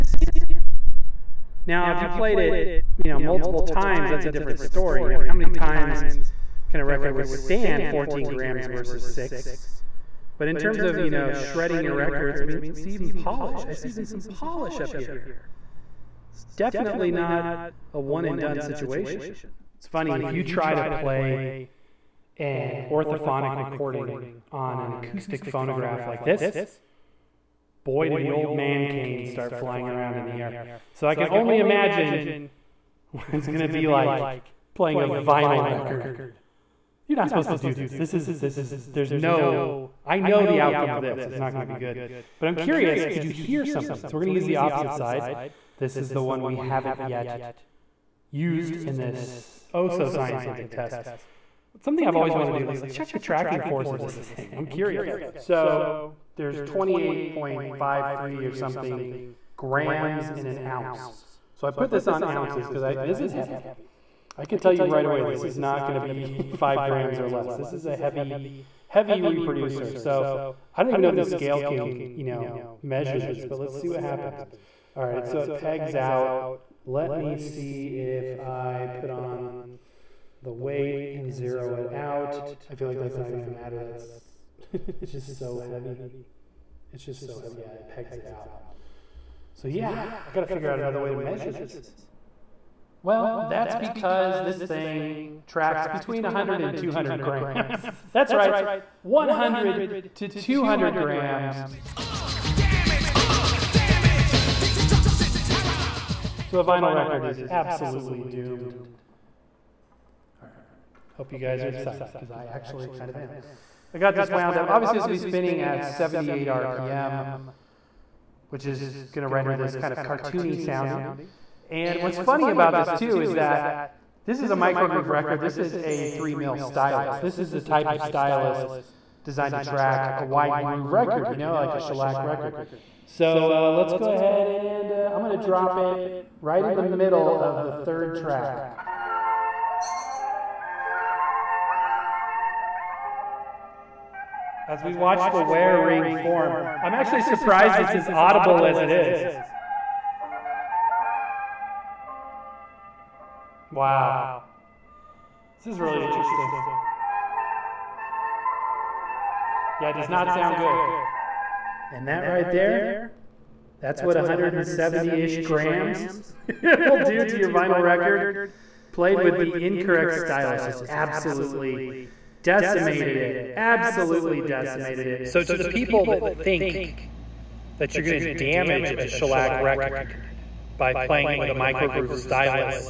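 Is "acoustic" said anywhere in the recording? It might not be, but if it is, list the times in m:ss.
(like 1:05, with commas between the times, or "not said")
0:24.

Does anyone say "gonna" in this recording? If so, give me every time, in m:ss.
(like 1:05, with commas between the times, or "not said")
1:23, 2:58.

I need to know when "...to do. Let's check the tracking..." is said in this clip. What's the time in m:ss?
0:52.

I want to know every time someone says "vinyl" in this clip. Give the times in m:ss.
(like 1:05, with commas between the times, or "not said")
0:35, 1:46, 2:47.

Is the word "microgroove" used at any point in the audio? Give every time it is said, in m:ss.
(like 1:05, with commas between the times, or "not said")
2:04, 3:01.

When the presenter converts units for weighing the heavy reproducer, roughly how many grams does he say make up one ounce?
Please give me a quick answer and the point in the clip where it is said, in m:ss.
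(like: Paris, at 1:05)
28.53, at 0:56.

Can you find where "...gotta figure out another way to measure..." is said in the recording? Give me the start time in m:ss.
1:30.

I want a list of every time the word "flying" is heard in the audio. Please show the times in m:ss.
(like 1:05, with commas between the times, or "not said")
0:29.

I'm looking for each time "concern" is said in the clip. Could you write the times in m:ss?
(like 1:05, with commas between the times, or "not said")
not said.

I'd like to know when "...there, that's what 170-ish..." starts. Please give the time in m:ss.
2:42.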